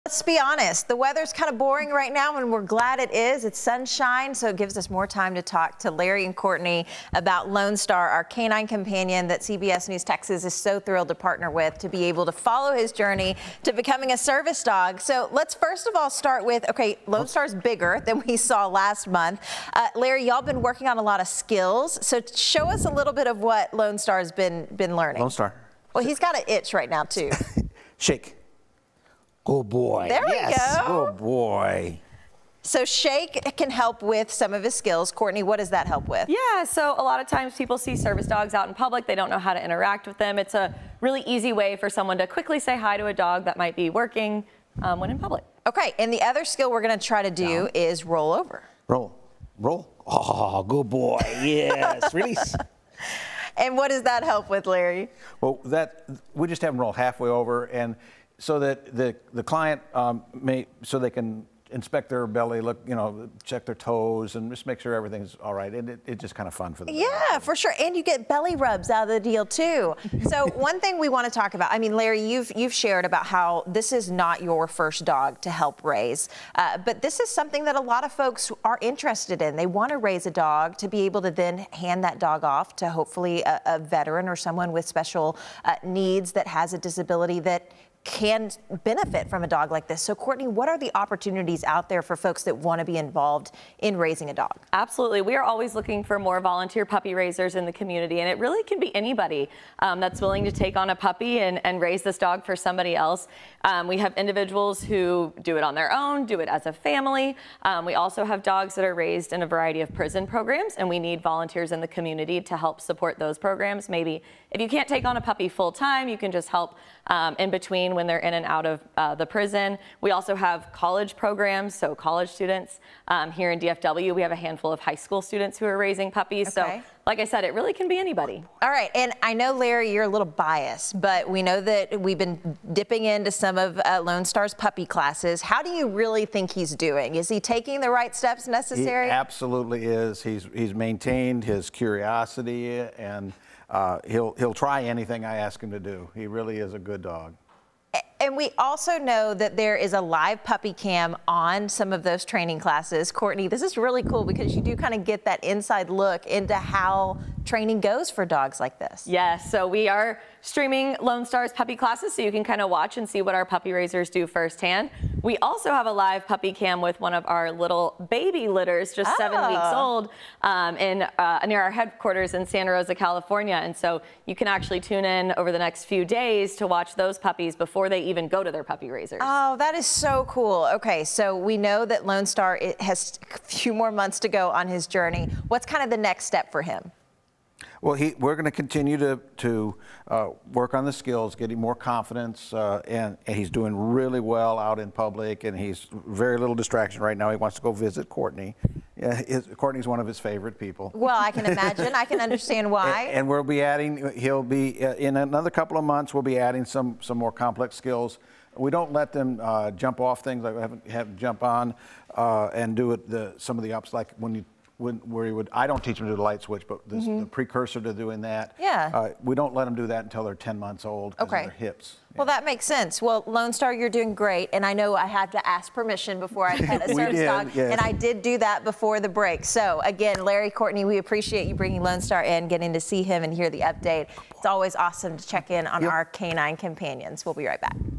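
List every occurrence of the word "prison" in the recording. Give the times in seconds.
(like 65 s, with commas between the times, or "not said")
109 s, 119 s.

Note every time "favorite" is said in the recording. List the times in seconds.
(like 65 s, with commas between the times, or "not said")
200 s.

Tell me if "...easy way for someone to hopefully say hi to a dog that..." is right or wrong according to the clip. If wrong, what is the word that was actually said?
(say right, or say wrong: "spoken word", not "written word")
wrong: "quickly", not "hopefully".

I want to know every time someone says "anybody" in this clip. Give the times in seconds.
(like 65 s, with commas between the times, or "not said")
98 s, 127 s.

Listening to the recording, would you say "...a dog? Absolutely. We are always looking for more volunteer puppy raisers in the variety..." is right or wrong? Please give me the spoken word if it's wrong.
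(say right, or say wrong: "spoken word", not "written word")
wrong: "community", not "variety".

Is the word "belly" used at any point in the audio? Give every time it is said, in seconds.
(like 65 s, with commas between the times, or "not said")
62 s, 68 s.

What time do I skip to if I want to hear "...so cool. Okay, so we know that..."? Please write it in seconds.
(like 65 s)
179 s.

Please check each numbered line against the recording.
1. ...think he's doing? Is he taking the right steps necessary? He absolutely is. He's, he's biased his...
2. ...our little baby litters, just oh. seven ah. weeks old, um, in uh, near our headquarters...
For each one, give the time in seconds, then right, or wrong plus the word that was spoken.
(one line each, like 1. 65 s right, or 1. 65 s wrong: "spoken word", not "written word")
1. 136 s wrong: "maintained", not "biased"
2. 167 s right.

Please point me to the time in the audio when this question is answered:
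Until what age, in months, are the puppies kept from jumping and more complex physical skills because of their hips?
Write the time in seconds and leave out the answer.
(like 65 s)
220 s.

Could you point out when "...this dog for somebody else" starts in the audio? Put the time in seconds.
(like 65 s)
102 s.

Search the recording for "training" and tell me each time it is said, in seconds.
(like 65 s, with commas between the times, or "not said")
152 s, 157 s.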